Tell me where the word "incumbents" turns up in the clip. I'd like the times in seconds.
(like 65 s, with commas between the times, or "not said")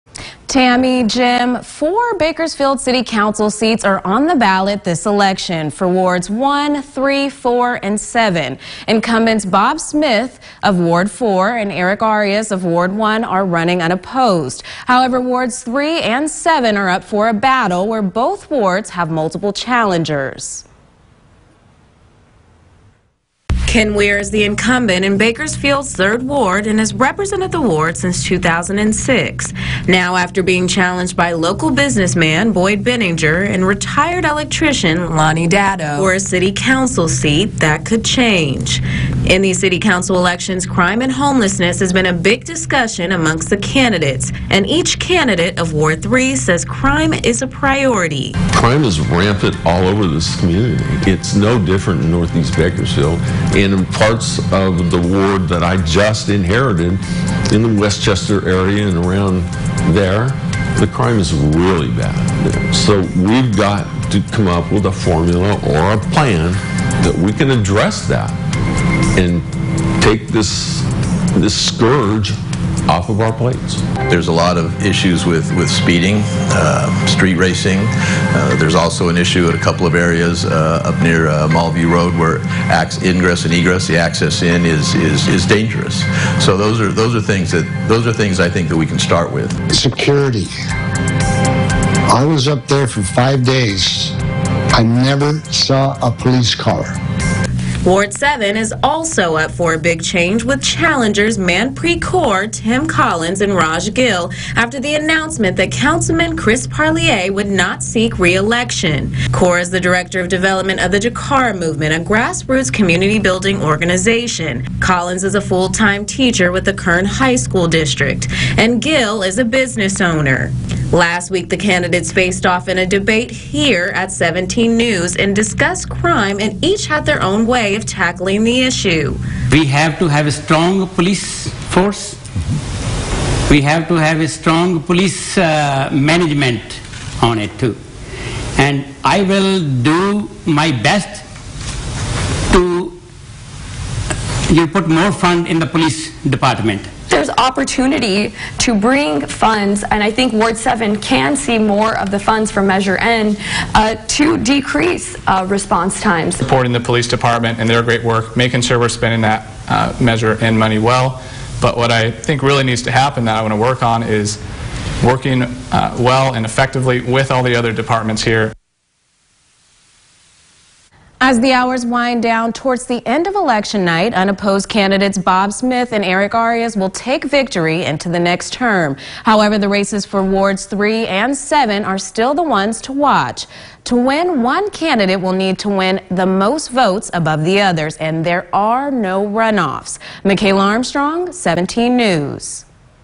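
8 s, 24 s.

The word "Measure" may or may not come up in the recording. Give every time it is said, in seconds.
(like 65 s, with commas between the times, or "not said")
152 s, 160 s.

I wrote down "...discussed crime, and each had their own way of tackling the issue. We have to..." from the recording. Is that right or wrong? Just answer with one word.
right.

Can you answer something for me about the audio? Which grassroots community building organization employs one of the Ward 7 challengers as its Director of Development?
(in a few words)
Jakara Movement.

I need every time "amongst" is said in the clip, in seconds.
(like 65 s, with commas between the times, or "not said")
43 s.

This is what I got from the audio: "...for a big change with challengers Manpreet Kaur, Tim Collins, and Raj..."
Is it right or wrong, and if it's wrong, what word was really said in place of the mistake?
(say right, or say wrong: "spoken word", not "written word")
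right.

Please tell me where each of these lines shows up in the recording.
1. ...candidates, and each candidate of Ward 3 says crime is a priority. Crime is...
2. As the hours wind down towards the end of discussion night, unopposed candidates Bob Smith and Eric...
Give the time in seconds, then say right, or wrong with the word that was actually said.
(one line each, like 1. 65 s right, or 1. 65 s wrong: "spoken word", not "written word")
1. 43 s right
2. 171 s wrong: "election", not "discussion".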